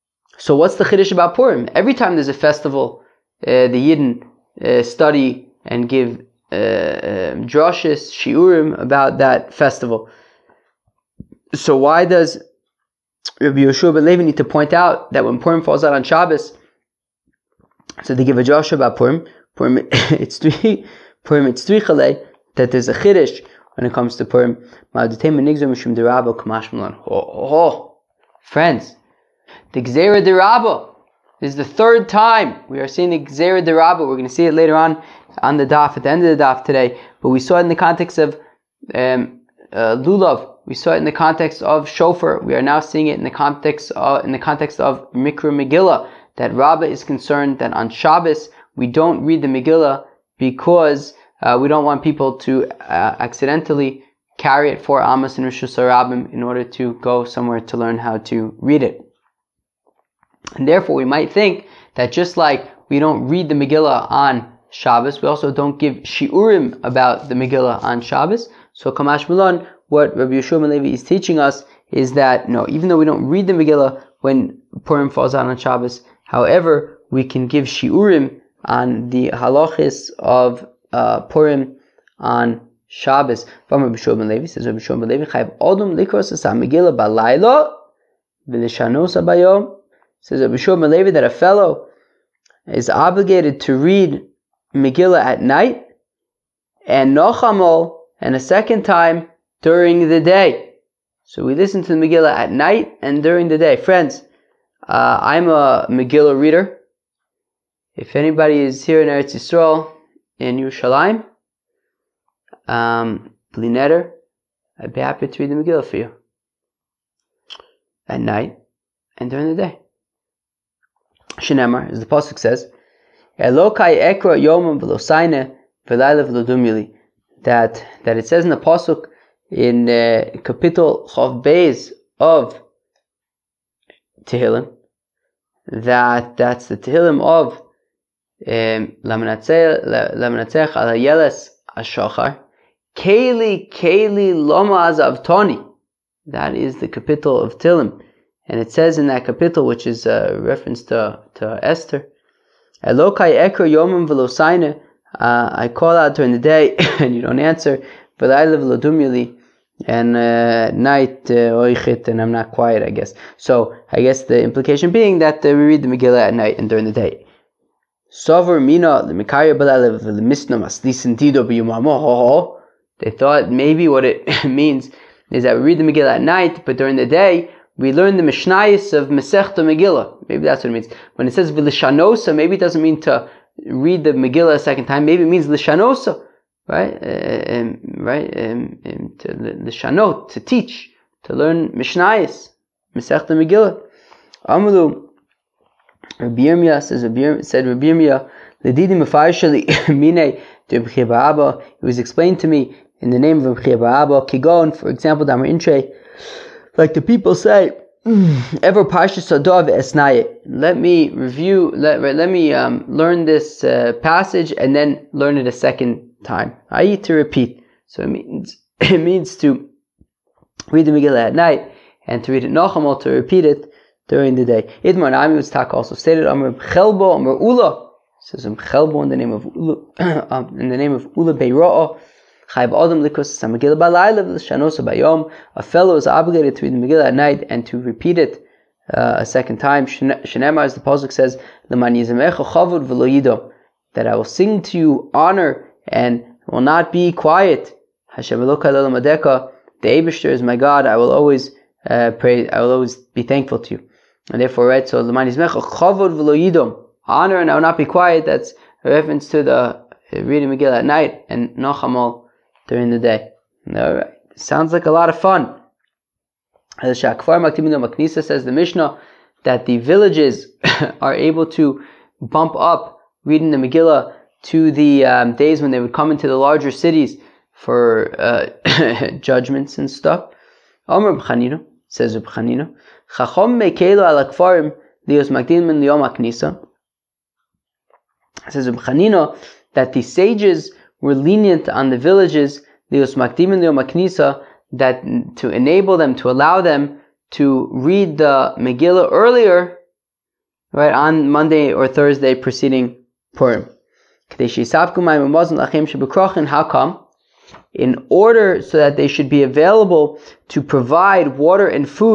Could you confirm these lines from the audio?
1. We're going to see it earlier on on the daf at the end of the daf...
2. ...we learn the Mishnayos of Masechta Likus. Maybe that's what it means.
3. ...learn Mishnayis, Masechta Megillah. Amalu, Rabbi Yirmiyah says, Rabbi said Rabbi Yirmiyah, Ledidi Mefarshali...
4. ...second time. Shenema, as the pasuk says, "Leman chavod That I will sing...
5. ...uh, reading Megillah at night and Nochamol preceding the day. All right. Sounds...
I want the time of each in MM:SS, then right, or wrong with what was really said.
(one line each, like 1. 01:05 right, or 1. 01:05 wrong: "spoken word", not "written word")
1. 00:34 wrong: "later", not "earlier"
2. 02:57 wrong: "Megillah", not "Likus"
3. 03:11 right
4. 03:59 right
5. 04:19 wrong: "during", not "preceding".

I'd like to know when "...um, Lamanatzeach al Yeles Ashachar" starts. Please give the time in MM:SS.
02:18.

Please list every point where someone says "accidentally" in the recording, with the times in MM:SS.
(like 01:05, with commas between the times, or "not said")
00:53.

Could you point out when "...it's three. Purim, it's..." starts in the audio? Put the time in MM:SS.
00:19.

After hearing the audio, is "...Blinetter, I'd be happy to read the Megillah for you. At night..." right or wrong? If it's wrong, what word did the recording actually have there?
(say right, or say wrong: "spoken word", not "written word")
right.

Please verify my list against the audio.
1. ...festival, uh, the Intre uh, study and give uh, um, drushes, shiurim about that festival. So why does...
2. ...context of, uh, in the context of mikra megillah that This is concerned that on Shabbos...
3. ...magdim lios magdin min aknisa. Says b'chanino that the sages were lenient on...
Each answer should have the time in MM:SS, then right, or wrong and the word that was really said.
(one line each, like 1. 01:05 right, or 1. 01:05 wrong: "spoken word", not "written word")
1. 00:02 wrong: "Yidden", not "Intre"
2. 00:43 wrong: "Rabbah", not "This"
3. 04:44 wrong: "akfarim", not "magdim".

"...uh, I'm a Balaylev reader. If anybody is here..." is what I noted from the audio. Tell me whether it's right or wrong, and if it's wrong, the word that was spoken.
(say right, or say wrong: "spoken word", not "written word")
wrong: "Megillah", not "Balaylev".